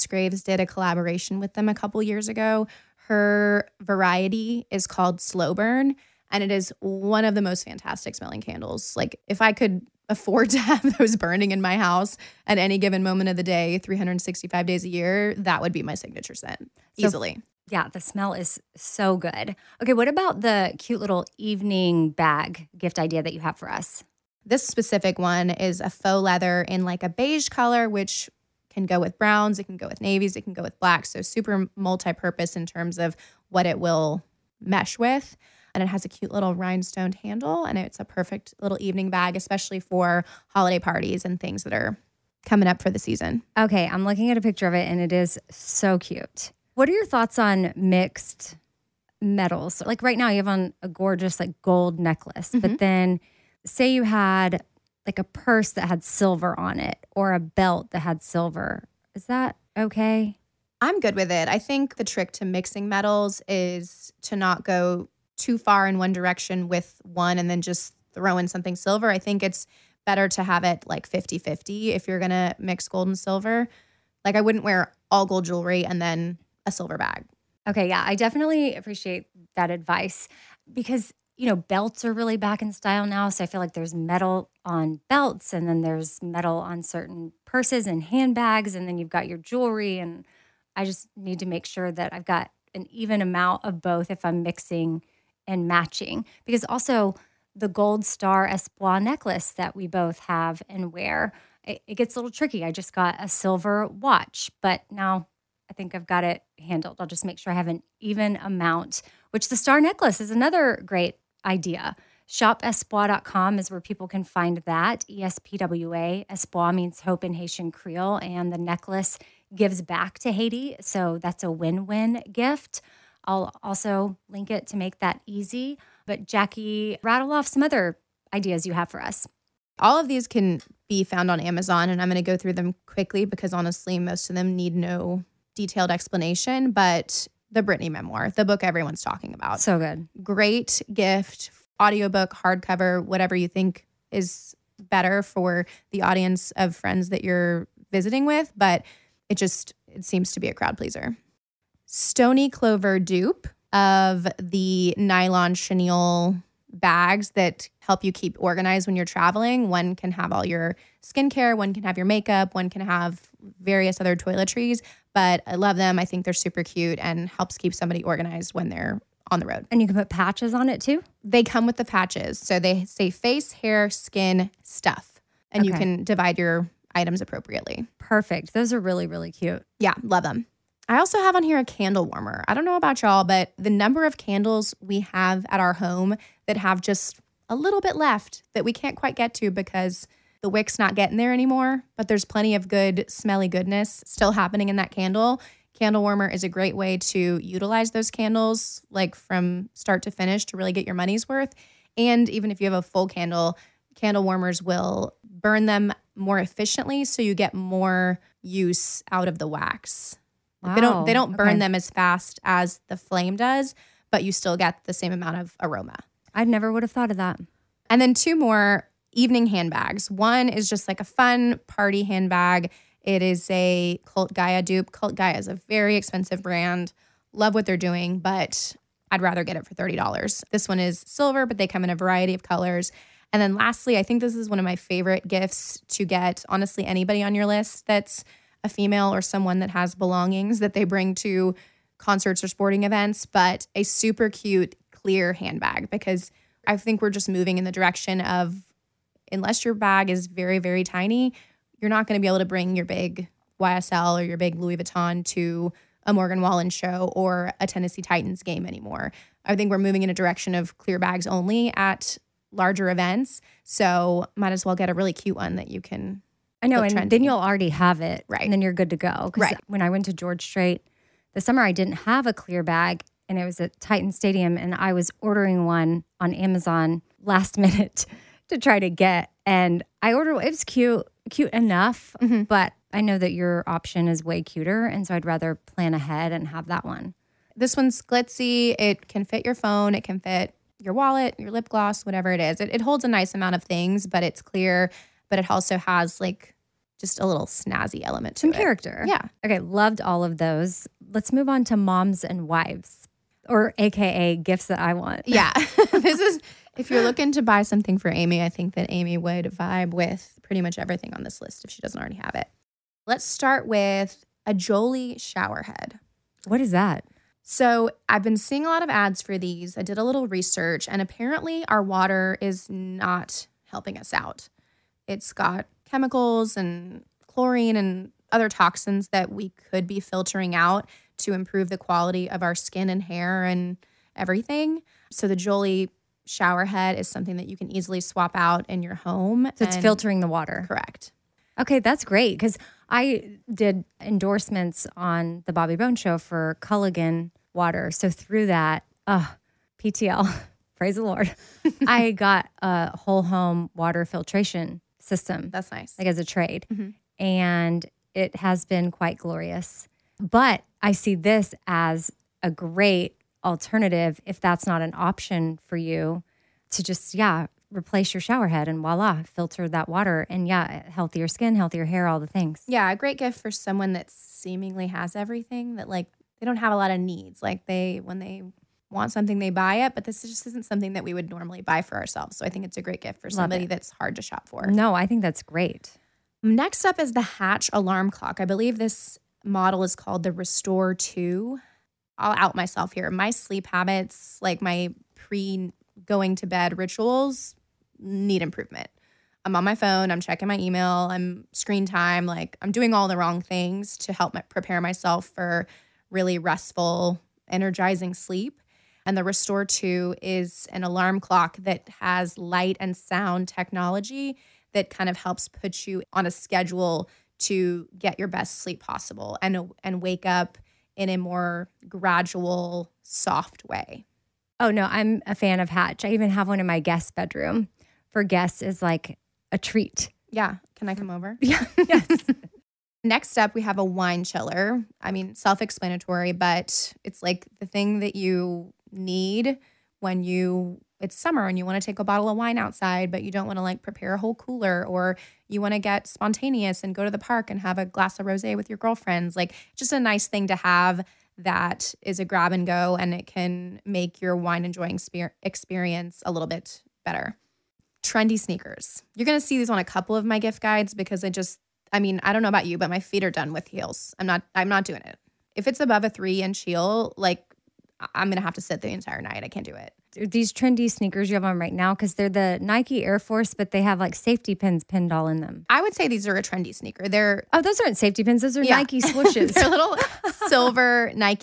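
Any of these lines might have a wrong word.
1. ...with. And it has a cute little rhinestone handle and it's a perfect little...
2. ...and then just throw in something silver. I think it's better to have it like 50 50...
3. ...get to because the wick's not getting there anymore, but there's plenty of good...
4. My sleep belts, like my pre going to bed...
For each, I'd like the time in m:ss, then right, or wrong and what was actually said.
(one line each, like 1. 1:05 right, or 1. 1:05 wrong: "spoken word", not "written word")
1. 0:34 right
2. 1:07 right
3. 3:09 right
4. 6:33 wrong: "habits", not "belts".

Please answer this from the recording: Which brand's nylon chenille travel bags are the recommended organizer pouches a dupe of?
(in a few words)
Stoney Clover.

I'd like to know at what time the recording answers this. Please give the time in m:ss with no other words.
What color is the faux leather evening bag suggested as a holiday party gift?
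0:27.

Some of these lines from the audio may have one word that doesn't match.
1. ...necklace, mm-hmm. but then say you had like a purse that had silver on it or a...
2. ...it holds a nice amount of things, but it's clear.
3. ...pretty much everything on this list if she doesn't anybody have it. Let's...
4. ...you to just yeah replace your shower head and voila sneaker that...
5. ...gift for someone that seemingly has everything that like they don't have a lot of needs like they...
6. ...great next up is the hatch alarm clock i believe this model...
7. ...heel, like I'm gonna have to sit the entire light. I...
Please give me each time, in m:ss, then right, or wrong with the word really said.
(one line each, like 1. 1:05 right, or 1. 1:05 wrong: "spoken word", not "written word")
1. 0:51 right
2. 4:52 right
3. 5:10 wrong: "already", not "anybody"
4. 6:05 wrong: "filter", not "sneaker"
5. 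6:13 right
6. 6:25 right
7. 7:46 wrong: "night", not "light".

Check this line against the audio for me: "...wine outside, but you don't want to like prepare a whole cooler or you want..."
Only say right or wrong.
right.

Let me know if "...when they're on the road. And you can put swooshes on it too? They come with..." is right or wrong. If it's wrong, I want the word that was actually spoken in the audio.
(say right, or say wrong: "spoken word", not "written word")
wrong: "patches", not "swooshes".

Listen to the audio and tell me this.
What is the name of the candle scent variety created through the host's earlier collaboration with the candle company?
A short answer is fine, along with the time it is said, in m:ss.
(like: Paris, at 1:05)
Slow Burn, at 0:05.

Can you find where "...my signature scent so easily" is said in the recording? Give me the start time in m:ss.
0:15.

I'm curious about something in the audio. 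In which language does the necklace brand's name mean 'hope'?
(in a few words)
Haitian Creole.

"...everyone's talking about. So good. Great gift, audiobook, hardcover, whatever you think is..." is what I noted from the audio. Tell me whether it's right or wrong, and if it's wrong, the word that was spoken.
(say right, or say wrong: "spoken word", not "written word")
right.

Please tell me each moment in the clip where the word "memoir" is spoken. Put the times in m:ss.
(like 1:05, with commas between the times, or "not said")
2:17.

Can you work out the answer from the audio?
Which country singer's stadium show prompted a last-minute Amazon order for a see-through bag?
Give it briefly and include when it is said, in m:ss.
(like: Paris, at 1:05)
George Strait, at 4:30.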